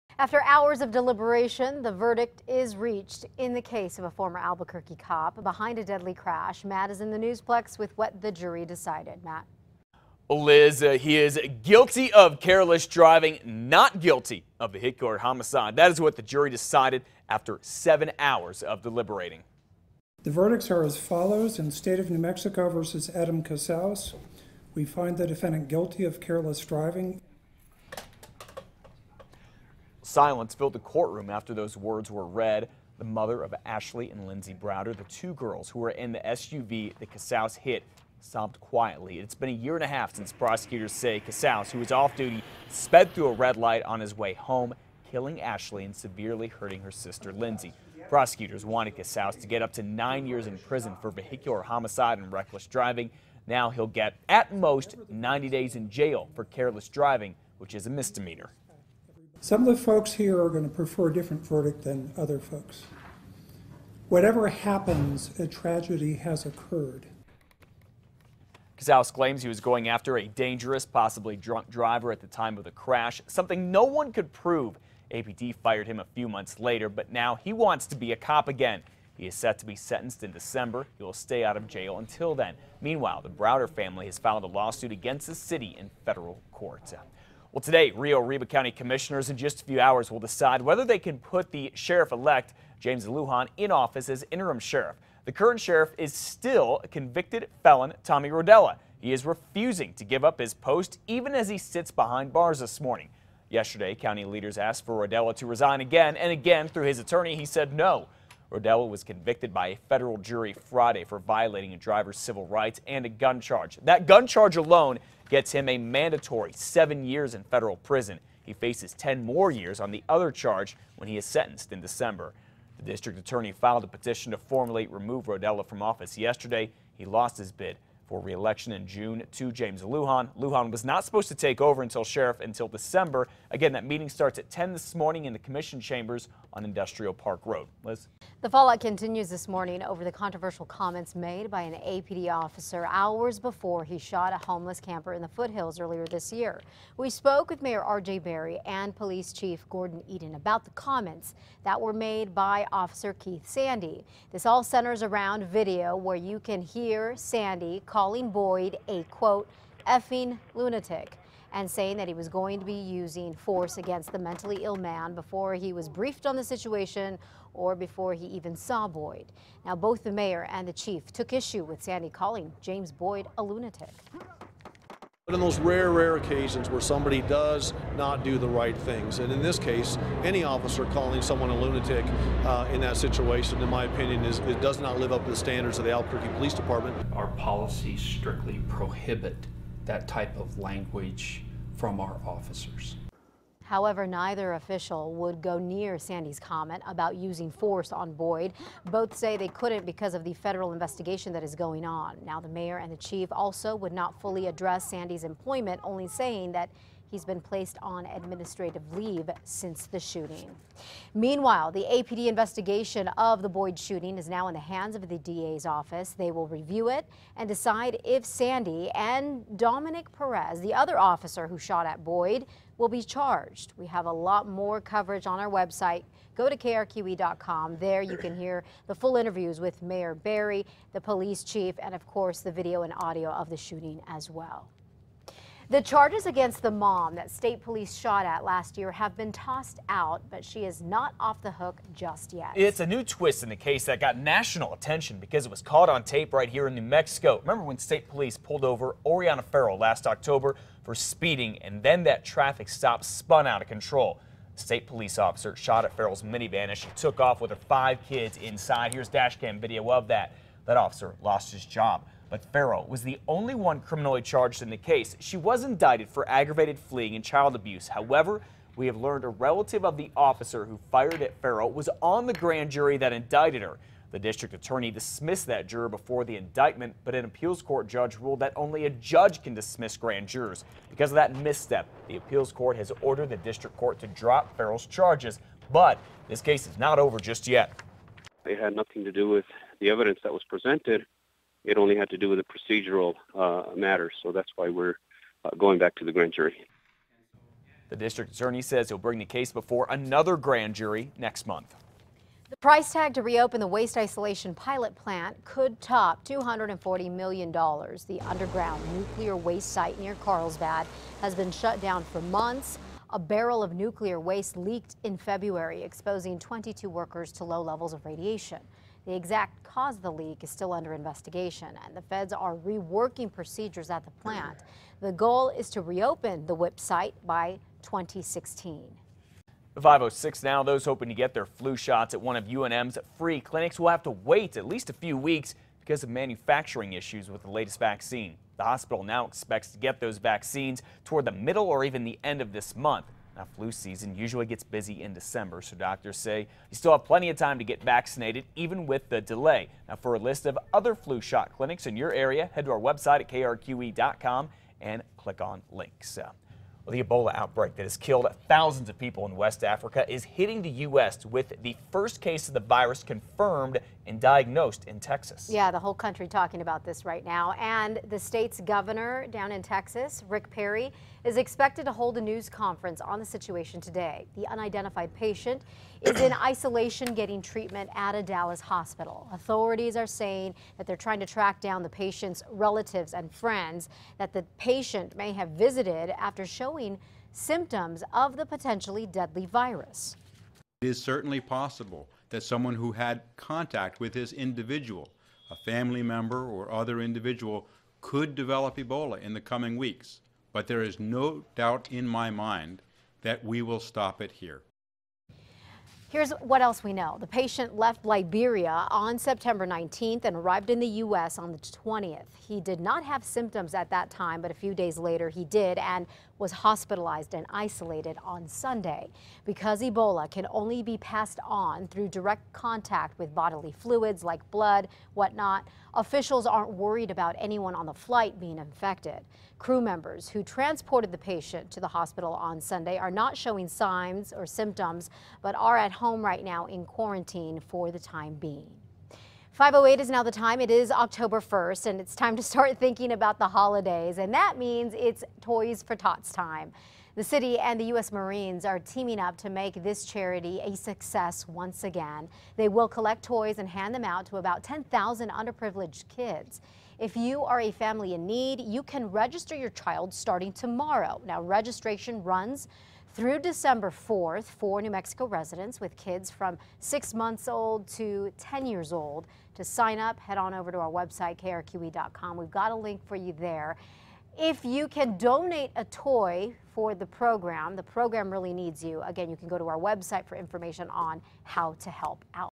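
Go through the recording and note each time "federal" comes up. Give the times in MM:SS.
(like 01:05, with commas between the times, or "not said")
01:26, 01:49, 01:57, 03:20.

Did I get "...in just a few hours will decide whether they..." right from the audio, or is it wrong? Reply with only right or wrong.
right.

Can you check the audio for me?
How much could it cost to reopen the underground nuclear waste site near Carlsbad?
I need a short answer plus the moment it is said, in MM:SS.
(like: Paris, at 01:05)
$240 million, at 05:06.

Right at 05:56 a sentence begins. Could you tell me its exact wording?
Uh, well, the Ebola outbreak that has killed thousands of people in West Africa is hitting the U.S.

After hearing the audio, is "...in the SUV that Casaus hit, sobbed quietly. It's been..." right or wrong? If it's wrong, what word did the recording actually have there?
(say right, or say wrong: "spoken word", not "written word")
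right.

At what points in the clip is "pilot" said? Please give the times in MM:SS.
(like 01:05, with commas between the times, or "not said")
05:04.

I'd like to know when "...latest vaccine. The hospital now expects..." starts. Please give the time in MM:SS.
05:37.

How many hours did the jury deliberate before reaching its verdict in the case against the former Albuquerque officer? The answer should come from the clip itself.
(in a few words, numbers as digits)
7.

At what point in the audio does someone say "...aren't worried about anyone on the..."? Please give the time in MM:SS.
07:06.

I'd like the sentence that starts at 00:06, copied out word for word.
Matt is in the newsplex with what the jury decided.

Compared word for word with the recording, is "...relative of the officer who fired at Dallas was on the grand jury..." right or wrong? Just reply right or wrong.
wrong.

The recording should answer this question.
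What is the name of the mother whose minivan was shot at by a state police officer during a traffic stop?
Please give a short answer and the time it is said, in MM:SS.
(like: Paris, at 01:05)
Oriana Farrell, at 04:09.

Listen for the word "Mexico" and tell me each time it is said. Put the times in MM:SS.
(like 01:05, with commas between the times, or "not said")
00:22, 04:06, 07:44.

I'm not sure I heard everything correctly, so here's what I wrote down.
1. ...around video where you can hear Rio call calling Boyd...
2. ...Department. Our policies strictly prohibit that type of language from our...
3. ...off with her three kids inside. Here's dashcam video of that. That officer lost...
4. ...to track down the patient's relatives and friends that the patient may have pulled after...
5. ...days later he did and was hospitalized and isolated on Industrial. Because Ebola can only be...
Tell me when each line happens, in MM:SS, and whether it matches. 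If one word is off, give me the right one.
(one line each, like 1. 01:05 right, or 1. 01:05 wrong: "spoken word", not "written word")
1. 02:35 wrong: "Sandy", not "Rio"
2. 03:06 right
3. 04:17 wrong: "five", not "three"
4. 06:21 wrong: "visited", not "pulled"
5. 06:54 wrong: "Sunday", not "Industrial".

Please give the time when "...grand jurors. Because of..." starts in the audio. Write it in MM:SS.
04:39.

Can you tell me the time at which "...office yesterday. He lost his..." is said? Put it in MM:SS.
02:05.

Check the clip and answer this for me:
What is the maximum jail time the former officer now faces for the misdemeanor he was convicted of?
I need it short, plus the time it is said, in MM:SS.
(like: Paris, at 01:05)
90 days, at 00:55.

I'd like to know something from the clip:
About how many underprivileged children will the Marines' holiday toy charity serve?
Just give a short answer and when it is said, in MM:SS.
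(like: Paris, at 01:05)
10,000, at 07:34.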